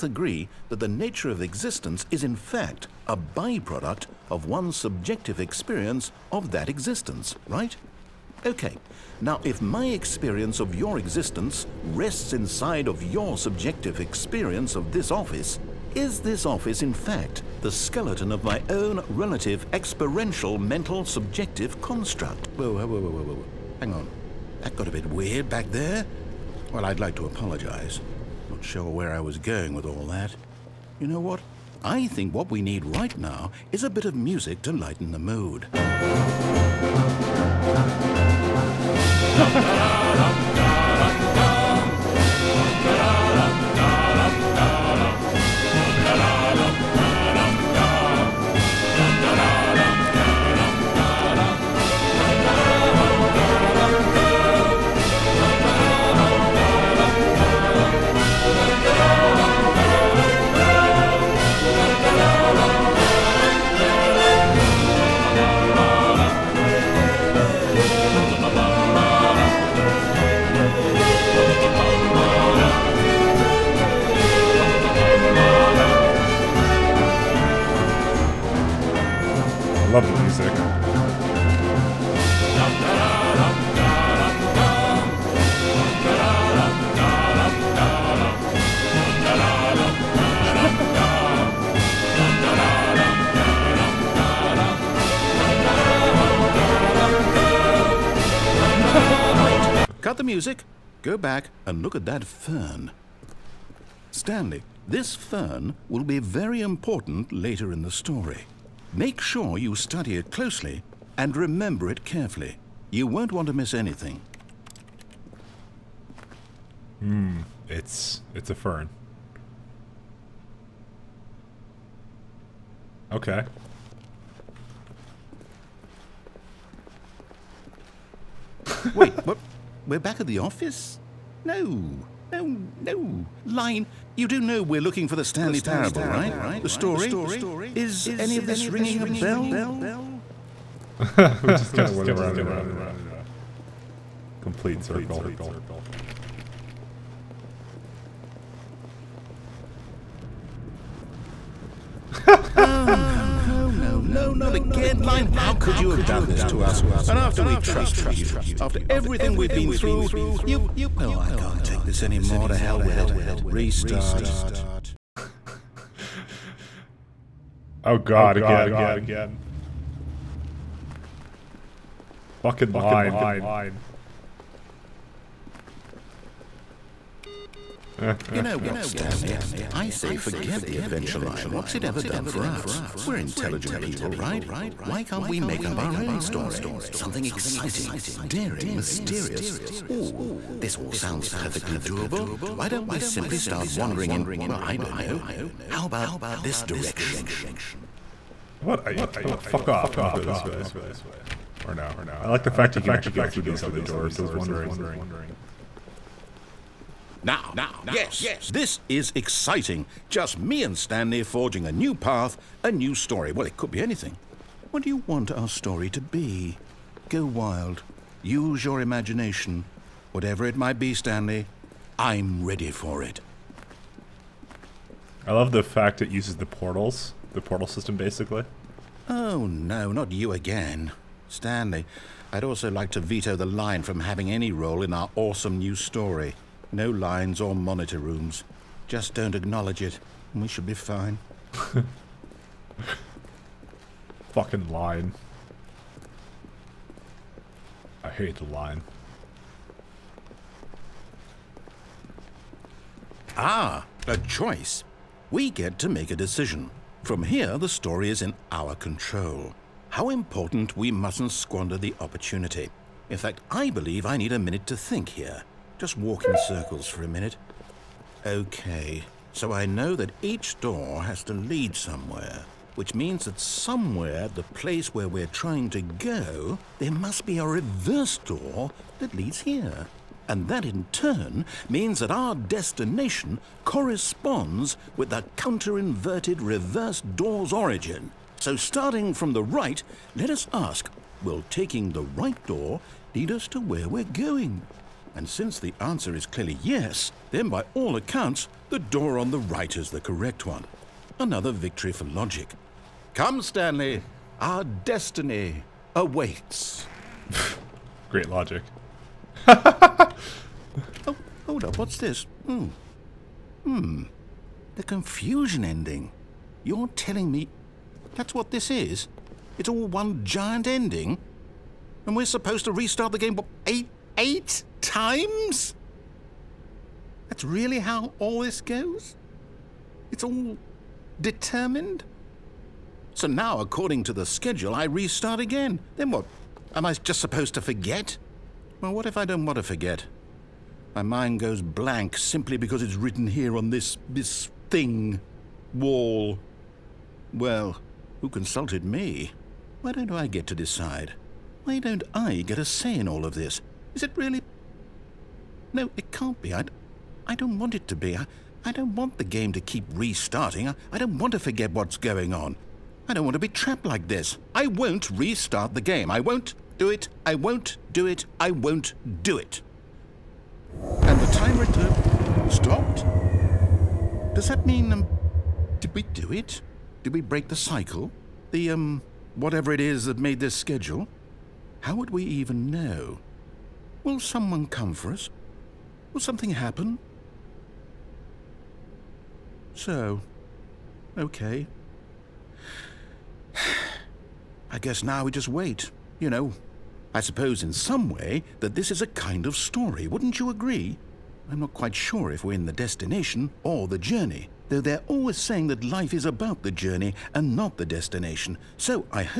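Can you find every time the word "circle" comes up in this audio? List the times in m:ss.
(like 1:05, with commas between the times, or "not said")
2:24, 4:26.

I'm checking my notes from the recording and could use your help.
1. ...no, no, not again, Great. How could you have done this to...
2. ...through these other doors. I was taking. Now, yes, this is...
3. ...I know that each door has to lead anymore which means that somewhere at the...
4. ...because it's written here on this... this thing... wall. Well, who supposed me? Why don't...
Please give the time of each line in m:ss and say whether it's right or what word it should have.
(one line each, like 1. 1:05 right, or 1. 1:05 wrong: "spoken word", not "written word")
1. 2:33 wrong: "Line", not "Great"
2. 3:23 wrong: "wondering", not "taking"
3. 4:29 wrong: "somewhere", not "anymore"
4. 5:42 wrong: "consulted", not "supposed".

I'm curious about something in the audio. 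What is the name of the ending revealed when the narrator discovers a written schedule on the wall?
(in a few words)
The confusion ending.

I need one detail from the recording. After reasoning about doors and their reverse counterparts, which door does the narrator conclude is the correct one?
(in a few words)
The right door.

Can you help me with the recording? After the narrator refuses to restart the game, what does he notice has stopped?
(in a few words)
The timer.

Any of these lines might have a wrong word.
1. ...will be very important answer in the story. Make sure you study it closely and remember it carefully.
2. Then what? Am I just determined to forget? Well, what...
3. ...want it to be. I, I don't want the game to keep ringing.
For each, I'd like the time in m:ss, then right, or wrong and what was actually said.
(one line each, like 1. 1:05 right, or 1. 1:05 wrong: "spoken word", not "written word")
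1. 1:45 wrong: "later", not "answer"
2. 5:35 wrong: "supposed", not "determined"
3. 5:57 wrong: "restarting", not "ringing".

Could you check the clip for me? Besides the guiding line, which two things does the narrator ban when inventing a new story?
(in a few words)
lines or monitor rooms.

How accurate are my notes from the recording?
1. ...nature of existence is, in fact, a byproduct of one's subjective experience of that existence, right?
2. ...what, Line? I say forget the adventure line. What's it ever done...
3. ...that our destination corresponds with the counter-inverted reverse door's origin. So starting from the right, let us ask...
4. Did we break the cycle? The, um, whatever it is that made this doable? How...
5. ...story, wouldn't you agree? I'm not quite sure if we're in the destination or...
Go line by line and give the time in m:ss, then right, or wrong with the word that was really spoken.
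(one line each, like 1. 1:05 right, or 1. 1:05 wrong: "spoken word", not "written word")
1. 0:00 right
2. 2:58 wrong: "Stanley", not "Line"
3. 4:41 right
4. 6:17 wrong: "schedule", not "doable"
5. 6:39 right.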